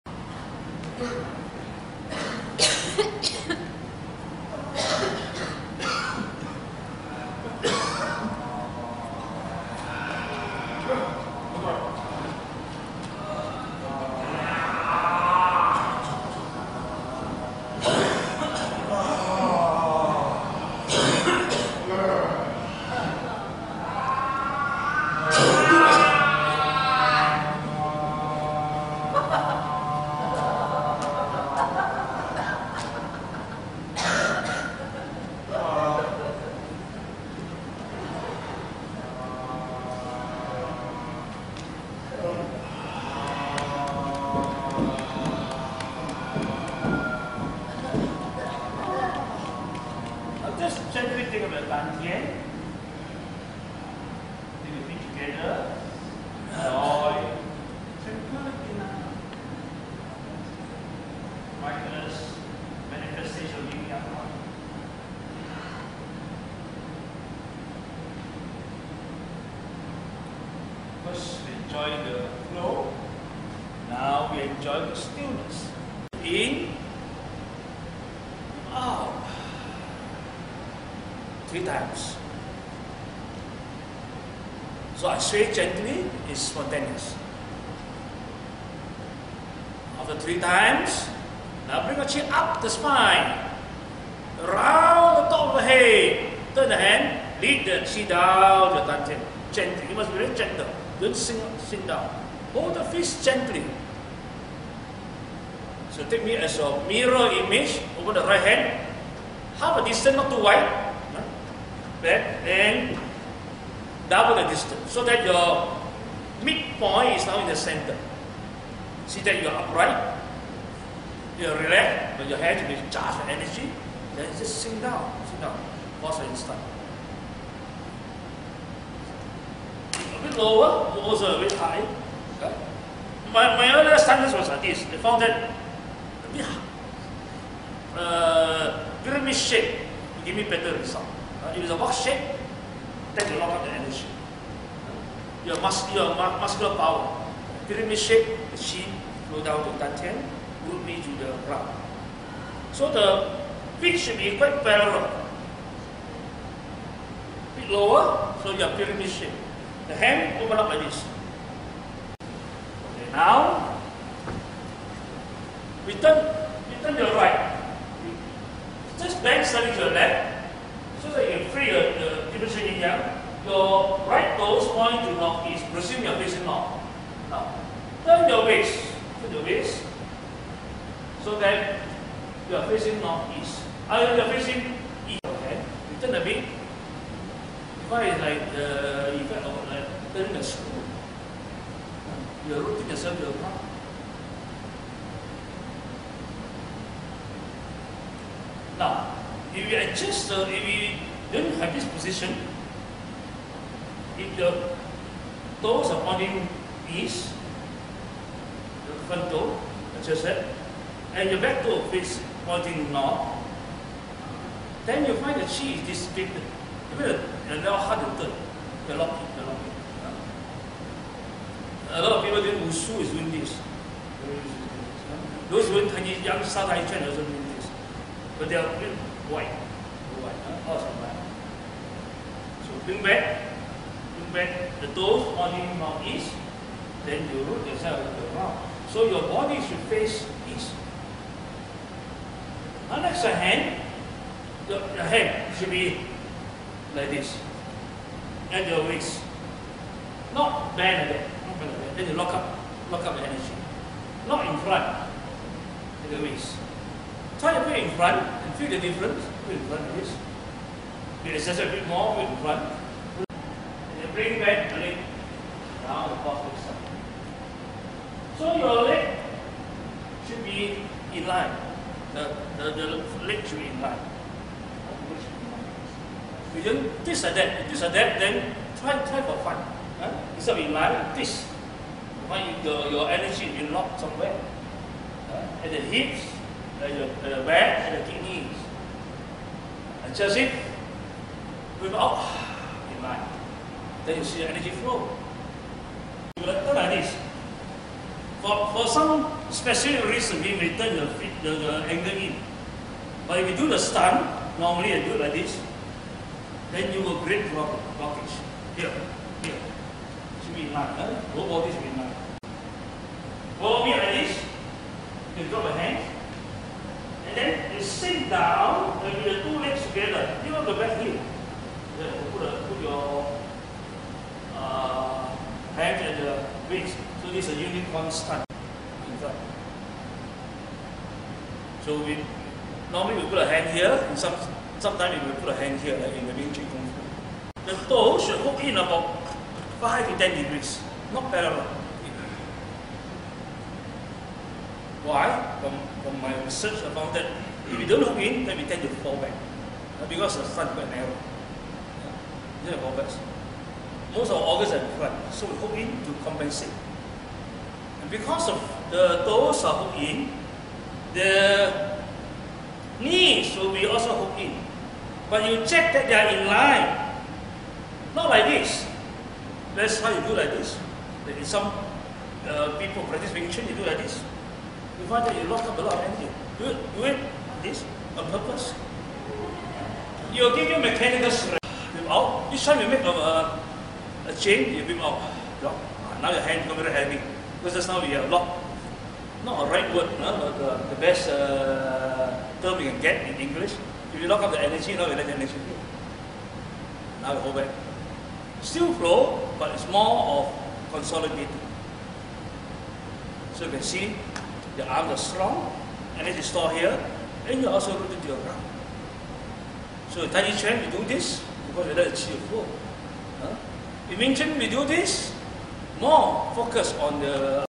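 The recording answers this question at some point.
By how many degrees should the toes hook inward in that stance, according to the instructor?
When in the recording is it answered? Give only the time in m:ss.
5:39.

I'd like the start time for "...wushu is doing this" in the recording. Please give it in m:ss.
3:42.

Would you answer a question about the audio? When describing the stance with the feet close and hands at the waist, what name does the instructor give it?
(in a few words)
Unicorn stance.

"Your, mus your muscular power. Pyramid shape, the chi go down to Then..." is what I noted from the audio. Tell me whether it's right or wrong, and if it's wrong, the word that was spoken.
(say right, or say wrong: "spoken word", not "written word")
wrong: "Dantian", not "Then".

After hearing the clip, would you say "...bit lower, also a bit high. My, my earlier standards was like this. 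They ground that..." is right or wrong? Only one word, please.
wrong.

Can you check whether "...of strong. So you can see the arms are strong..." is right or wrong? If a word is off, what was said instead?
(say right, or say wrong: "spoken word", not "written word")
wrong: "consolidating", not "strong".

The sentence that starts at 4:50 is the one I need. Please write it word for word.
And just it, breathe out in line.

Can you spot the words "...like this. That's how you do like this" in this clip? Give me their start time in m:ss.
6:08.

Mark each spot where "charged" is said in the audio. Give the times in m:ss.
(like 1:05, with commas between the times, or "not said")
2:02.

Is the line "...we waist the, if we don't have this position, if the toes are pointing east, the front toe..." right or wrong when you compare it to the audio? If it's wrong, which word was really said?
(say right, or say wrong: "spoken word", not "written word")
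wrong: "adjust", not "waist".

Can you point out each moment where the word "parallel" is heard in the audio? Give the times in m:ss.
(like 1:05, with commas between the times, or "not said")
2:34, 5:41.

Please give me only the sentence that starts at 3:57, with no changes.
Then you root yourself to the ground.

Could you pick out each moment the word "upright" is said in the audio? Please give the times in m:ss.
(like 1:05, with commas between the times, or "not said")
1:59.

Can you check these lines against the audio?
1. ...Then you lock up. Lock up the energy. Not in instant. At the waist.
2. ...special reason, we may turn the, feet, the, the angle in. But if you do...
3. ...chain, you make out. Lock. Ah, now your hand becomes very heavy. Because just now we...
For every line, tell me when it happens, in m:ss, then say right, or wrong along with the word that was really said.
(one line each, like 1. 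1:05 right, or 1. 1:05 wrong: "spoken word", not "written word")
1. 4:11 wrong: "front", not "instant"
2. 4:59 right
3. 6:24 right.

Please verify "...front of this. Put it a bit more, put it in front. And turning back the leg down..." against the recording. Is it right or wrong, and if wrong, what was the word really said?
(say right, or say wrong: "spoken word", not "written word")
wrong: "bring", not "turning".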